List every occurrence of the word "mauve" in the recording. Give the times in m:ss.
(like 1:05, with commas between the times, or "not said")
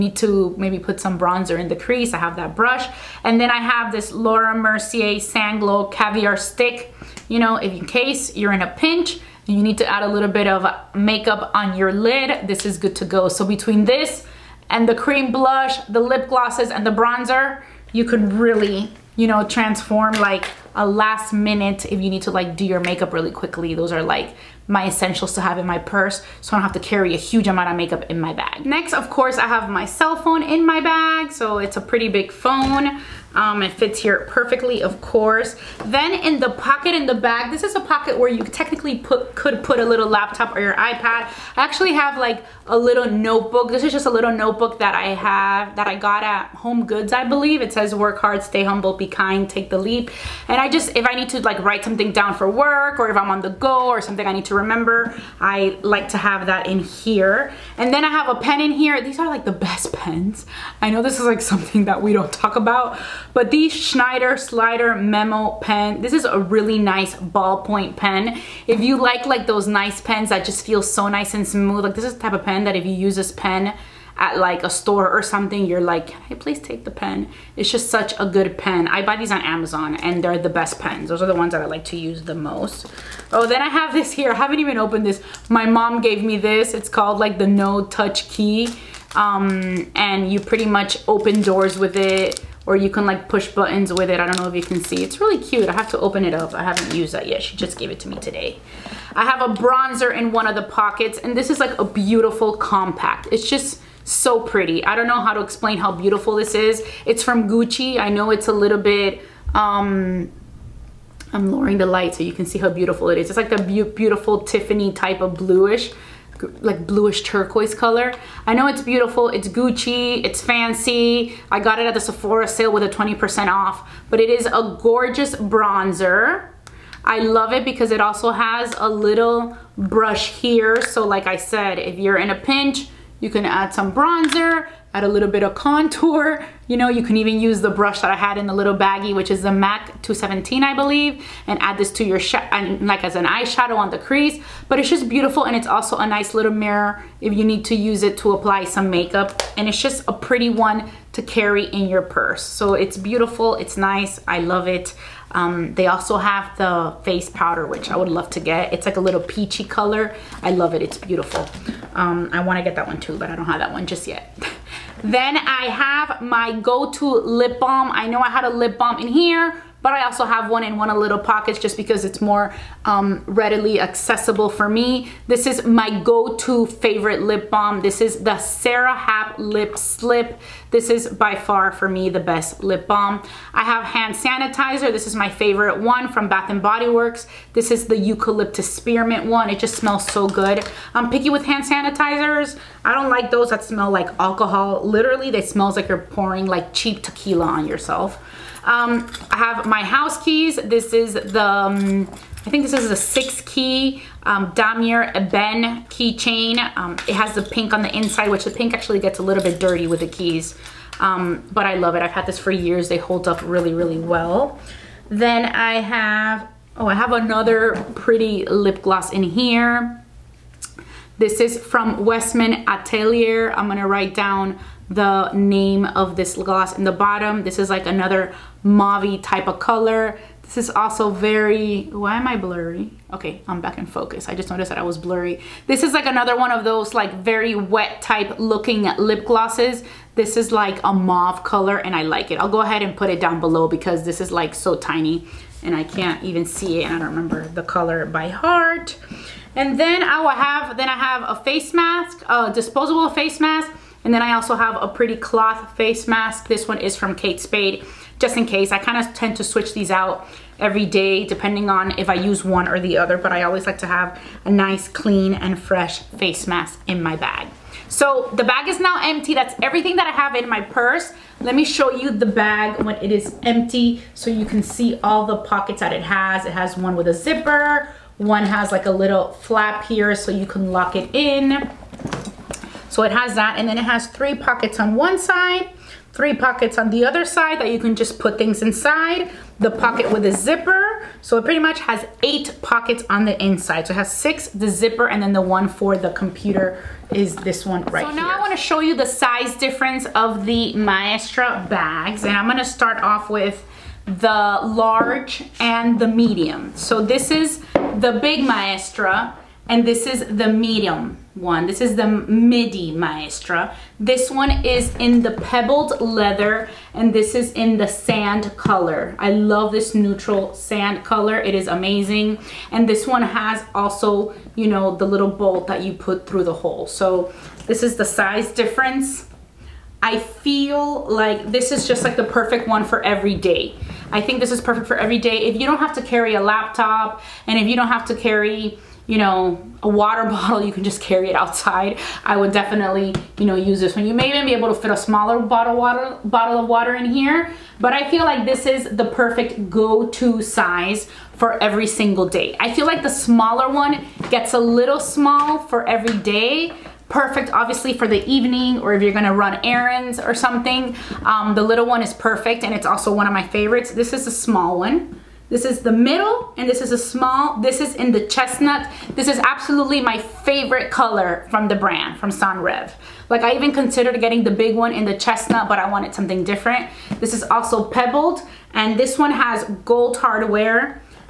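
3:48, 4:00.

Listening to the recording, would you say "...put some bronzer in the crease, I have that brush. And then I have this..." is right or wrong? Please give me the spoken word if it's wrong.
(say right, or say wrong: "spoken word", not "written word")
right.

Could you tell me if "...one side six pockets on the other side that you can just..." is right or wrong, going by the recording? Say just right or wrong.
wrong.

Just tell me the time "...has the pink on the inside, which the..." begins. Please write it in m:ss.
3:27.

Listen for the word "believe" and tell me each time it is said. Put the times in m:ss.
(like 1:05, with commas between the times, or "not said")
0:47, 2:20.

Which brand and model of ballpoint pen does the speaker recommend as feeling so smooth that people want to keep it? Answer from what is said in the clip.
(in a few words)
Schneider Slider Memo.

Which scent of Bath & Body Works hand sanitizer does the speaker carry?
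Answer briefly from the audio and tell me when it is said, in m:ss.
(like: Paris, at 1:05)
eucalyptus spearmint, at 3:07.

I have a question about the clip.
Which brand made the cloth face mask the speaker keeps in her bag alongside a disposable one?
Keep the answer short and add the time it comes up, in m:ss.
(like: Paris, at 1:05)
Kate Spade, at 4:17.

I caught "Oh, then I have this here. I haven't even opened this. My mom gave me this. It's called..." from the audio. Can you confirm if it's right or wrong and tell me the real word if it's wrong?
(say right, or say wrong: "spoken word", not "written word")
right.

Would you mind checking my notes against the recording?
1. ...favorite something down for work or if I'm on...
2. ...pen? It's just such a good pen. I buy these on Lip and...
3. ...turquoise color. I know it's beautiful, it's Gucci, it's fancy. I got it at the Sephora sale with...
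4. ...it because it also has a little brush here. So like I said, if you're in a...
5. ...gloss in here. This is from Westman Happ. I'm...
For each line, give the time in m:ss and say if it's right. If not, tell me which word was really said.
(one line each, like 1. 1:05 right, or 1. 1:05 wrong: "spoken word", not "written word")
1. 0:51 wrong: "write", not "favorite"
2. 1:16 wrong: "Amazon", not "Lip"
3. 1:57 right
4. 2:07 right
5. 3:38 wrong: "Atelier", not "Happ".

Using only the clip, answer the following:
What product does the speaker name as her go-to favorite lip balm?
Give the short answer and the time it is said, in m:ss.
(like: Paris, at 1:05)
Sara Happ Lip Slip, at 2:58.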